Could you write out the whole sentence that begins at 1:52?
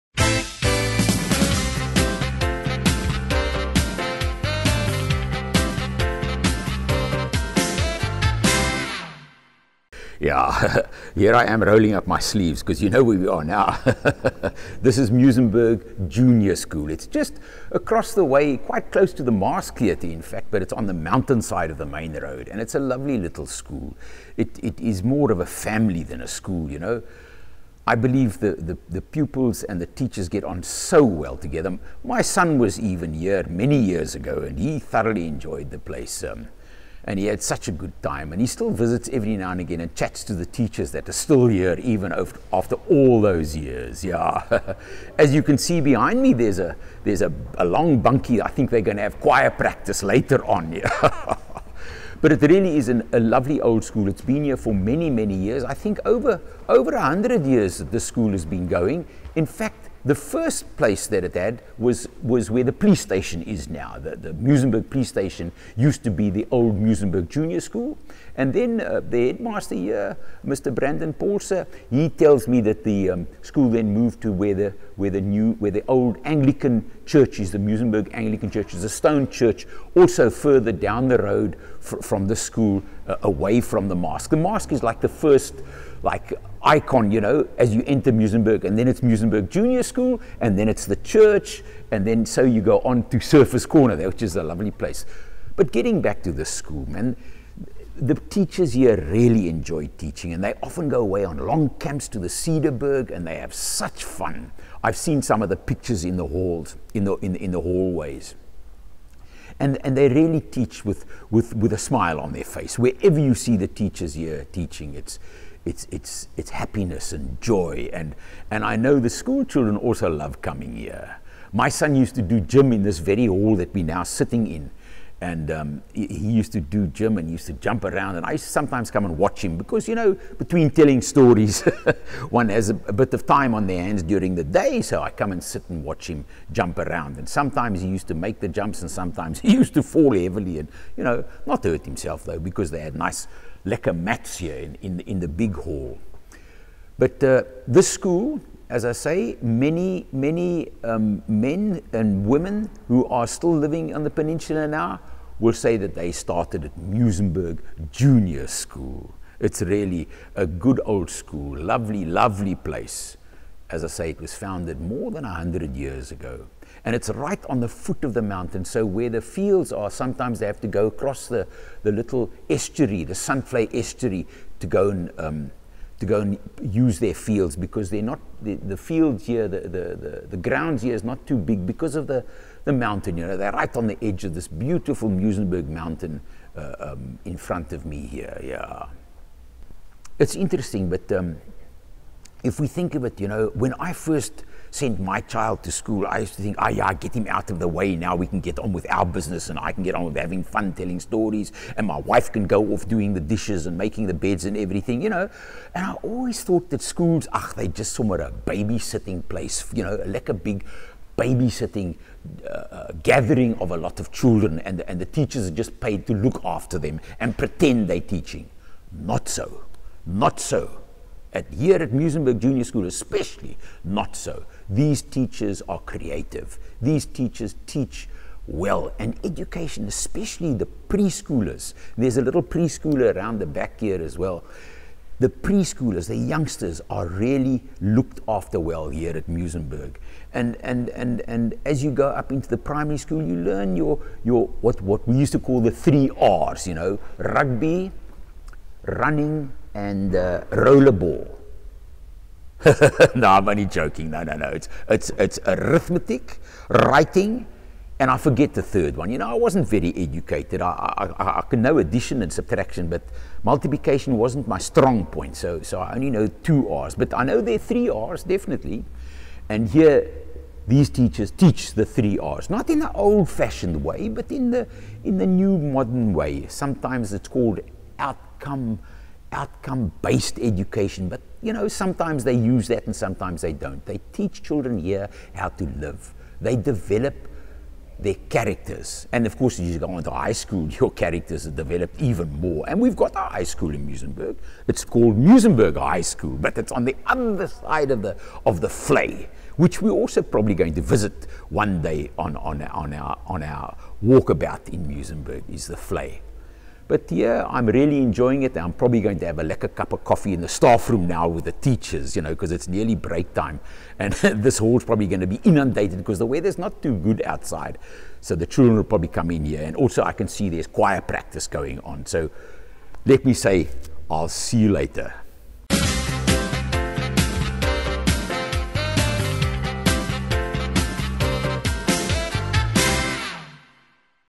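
Wherever you see the teachers here teaching, it's, it's, it's, it's happiness and joy.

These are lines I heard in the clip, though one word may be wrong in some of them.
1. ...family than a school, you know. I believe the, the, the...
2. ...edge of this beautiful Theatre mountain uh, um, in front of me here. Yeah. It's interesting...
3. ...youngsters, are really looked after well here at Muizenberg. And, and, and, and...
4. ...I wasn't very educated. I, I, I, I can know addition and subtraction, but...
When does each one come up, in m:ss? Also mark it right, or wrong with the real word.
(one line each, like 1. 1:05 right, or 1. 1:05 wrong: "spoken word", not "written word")
1. 0:25 right
2. 3:04 wrong: "Muizenberg", not "Theatre"
3. 3:56 right
4. 4:19 right.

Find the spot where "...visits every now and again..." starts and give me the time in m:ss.
0:38.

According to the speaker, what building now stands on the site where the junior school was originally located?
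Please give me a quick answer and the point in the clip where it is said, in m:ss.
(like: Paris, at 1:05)
Muizenberg police station, at 1:04.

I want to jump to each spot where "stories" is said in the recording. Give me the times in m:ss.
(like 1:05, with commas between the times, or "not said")
2:11, 3:21.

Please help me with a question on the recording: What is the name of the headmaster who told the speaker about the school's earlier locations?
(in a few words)
Brandon Paulser.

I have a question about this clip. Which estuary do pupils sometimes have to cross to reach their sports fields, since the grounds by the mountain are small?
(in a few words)
Zandvlei estuary.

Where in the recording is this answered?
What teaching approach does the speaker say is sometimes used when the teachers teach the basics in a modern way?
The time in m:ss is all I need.
4:39.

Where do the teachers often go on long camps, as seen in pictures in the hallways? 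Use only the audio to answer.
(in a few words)
Cederberg.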